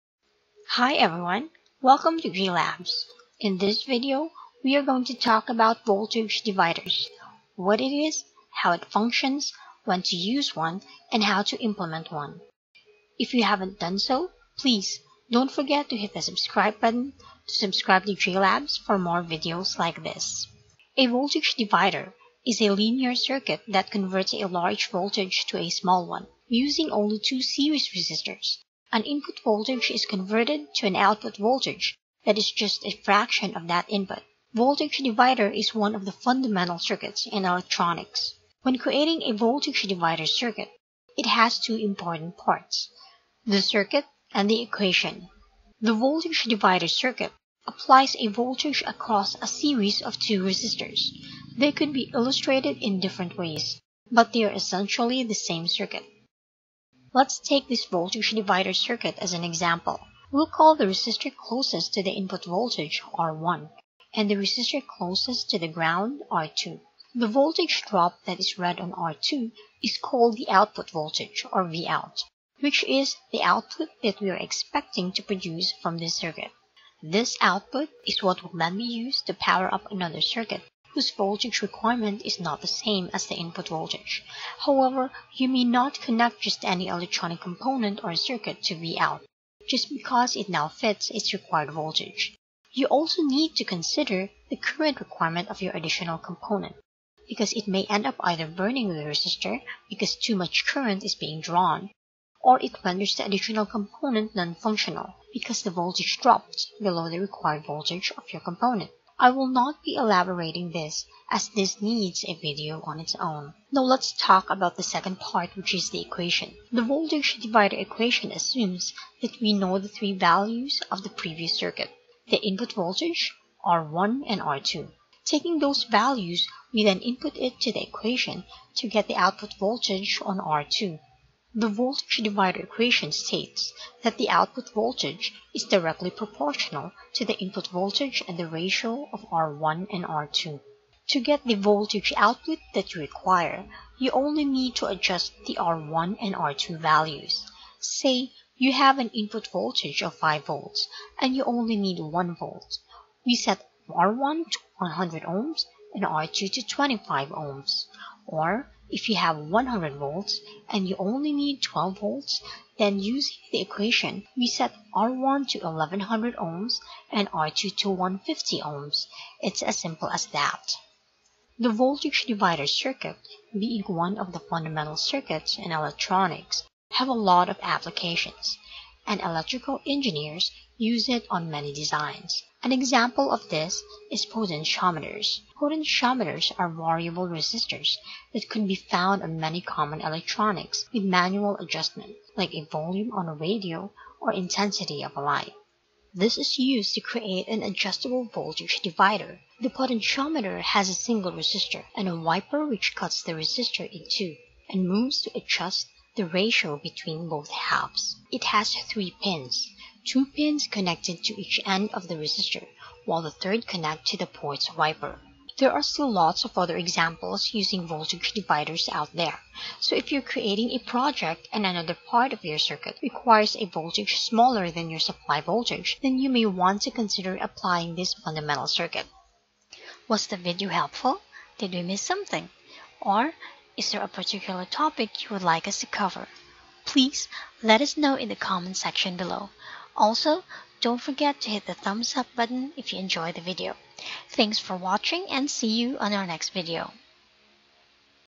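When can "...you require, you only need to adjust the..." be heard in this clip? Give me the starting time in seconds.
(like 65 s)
142 s.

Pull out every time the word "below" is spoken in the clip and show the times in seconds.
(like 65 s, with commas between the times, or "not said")
106 s, 239 s.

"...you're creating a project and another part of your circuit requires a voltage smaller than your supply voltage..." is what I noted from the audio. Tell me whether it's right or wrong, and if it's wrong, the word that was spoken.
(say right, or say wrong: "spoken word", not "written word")
right.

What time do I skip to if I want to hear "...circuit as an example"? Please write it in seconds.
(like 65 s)
58 s.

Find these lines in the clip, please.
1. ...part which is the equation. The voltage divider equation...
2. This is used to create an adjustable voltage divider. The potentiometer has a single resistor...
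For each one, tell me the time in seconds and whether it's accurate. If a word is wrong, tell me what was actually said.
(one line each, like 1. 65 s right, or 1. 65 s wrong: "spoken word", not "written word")
1. 115 s right
2. 196 s right.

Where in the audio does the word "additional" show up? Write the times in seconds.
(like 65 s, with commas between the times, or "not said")
95 s, 103 s.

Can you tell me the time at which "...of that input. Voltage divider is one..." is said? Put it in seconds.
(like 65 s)
33 s.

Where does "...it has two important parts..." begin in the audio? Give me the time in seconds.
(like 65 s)
41 s.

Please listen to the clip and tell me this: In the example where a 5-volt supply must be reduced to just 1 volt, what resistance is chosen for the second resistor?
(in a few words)
25 ohms.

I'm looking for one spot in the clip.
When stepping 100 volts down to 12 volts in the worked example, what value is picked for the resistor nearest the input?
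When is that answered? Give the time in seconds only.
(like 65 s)
165 s.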